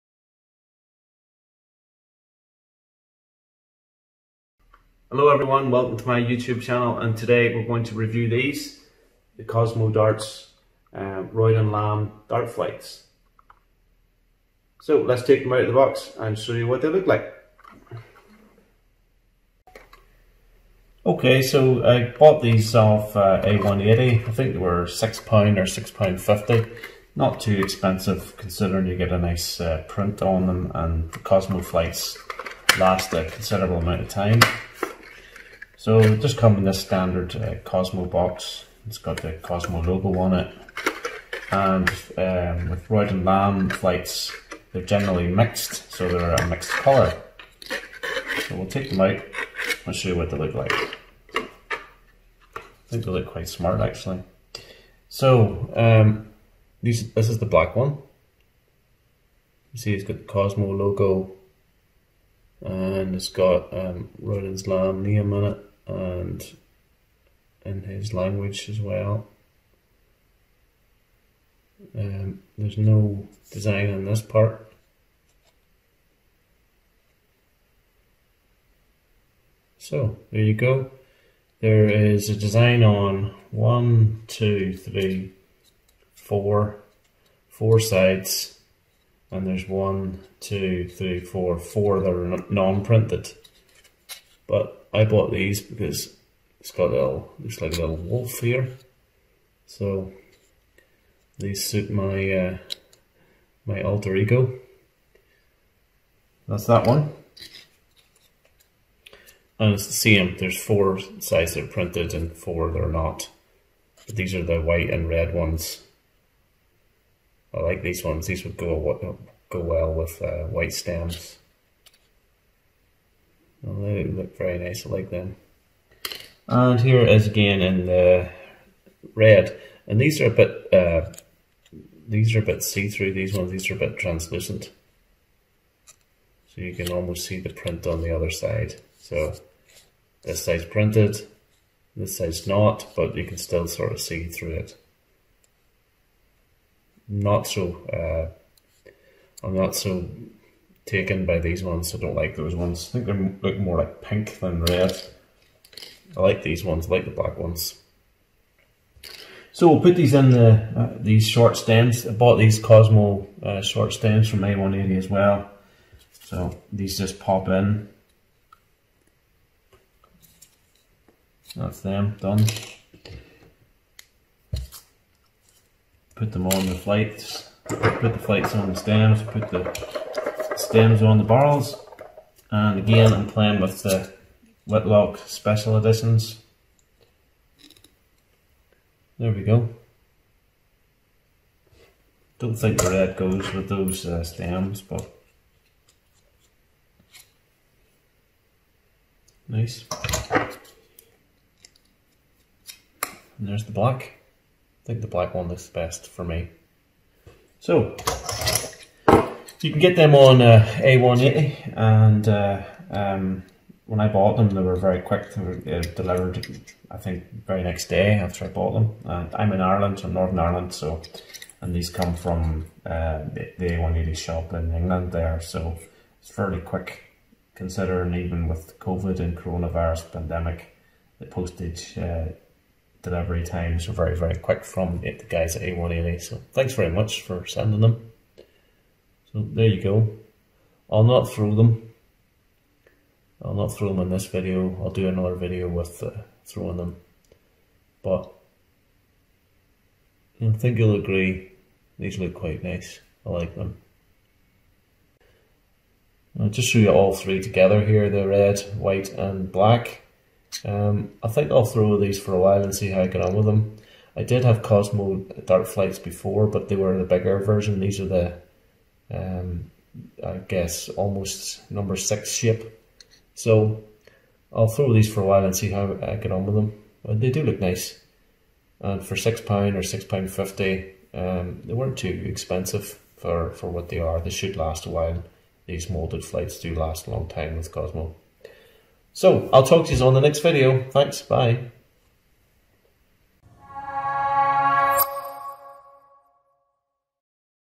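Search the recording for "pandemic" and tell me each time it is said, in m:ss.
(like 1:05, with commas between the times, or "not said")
3:50.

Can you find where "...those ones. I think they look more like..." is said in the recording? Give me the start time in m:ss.
2:32.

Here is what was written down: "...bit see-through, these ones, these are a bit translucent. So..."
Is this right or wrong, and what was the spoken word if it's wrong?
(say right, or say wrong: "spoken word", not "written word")
right.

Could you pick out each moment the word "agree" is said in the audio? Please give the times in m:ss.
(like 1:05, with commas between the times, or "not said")
4:10.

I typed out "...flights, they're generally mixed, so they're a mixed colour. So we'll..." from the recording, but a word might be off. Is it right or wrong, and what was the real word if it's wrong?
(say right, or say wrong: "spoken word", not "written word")
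right.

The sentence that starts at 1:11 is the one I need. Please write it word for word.
Um, there's no design on this part.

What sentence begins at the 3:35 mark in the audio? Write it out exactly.
They were uh, delivered, I think, very next day after I bought them.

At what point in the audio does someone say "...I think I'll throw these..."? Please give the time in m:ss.
4:21.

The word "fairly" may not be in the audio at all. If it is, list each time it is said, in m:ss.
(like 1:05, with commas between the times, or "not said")
3:46.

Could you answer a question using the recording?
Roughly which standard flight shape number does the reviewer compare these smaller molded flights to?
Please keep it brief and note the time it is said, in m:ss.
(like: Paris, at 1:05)
6, at 4:31.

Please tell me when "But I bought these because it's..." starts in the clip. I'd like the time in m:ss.
1:34.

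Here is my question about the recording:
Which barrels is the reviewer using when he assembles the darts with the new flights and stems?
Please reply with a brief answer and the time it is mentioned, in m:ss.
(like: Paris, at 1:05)
Whitlock Special Editions, at 3:04.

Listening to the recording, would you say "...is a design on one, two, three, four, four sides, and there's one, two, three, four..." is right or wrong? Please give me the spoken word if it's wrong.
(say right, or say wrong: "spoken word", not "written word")
right.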